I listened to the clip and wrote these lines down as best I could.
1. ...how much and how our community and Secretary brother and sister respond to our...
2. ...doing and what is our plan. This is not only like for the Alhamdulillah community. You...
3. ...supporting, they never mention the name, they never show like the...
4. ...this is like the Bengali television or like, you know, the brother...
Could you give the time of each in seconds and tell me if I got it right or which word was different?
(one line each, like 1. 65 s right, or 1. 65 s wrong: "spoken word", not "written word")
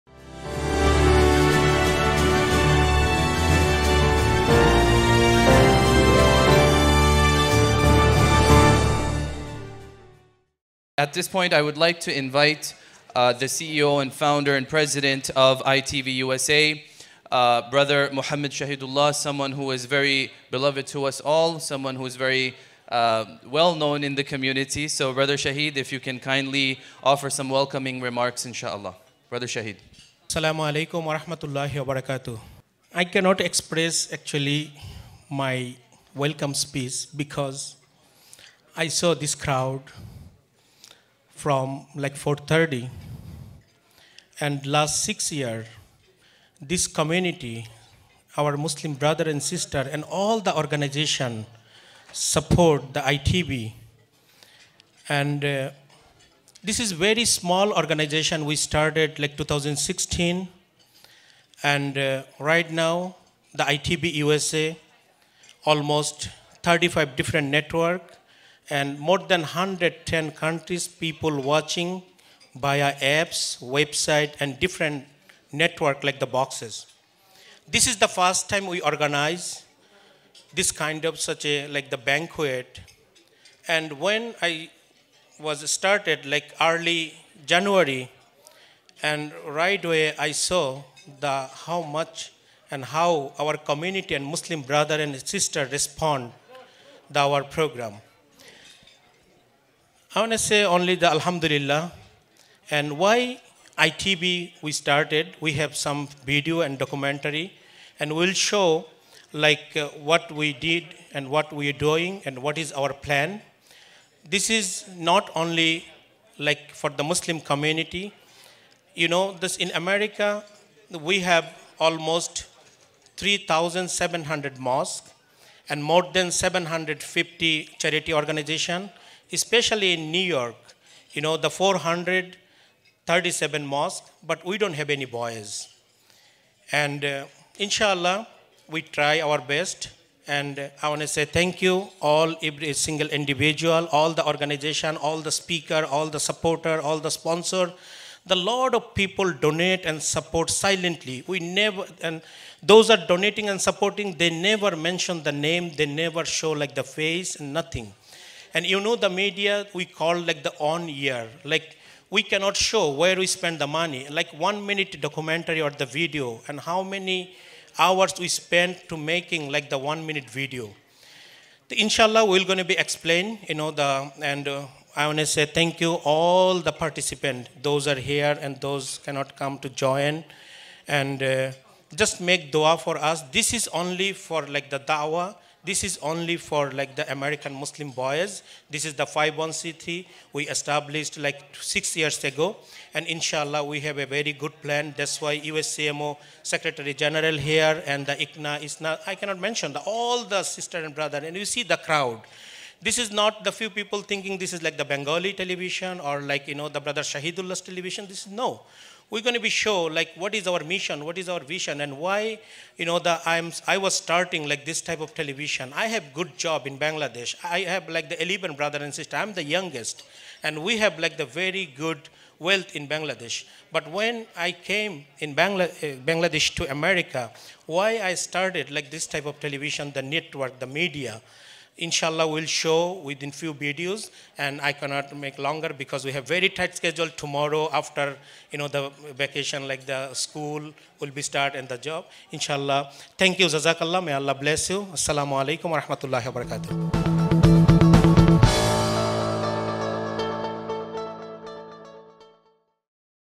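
1. 91 s wrong: "Muslim", not "Secretary"
2. 111 s wrong: "Muslim", not "Alhamdulillah"
3. 153 s right
4. 204 s right.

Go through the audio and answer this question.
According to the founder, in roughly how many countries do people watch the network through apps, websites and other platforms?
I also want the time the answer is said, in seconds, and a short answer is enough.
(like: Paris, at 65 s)
110, at 69 s.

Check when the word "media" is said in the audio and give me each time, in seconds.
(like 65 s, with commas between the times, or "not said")
159 s, 230 s.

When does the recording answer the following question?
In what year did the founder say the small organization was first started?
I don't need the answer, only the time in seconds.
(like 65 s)
59 s.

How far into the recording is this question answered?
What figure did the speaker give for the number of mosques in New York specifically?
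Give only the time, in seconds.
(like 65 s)
131 s.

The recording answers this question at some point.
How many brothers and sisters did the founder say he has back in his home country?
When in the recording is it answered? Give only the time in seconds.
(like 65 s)
218 s.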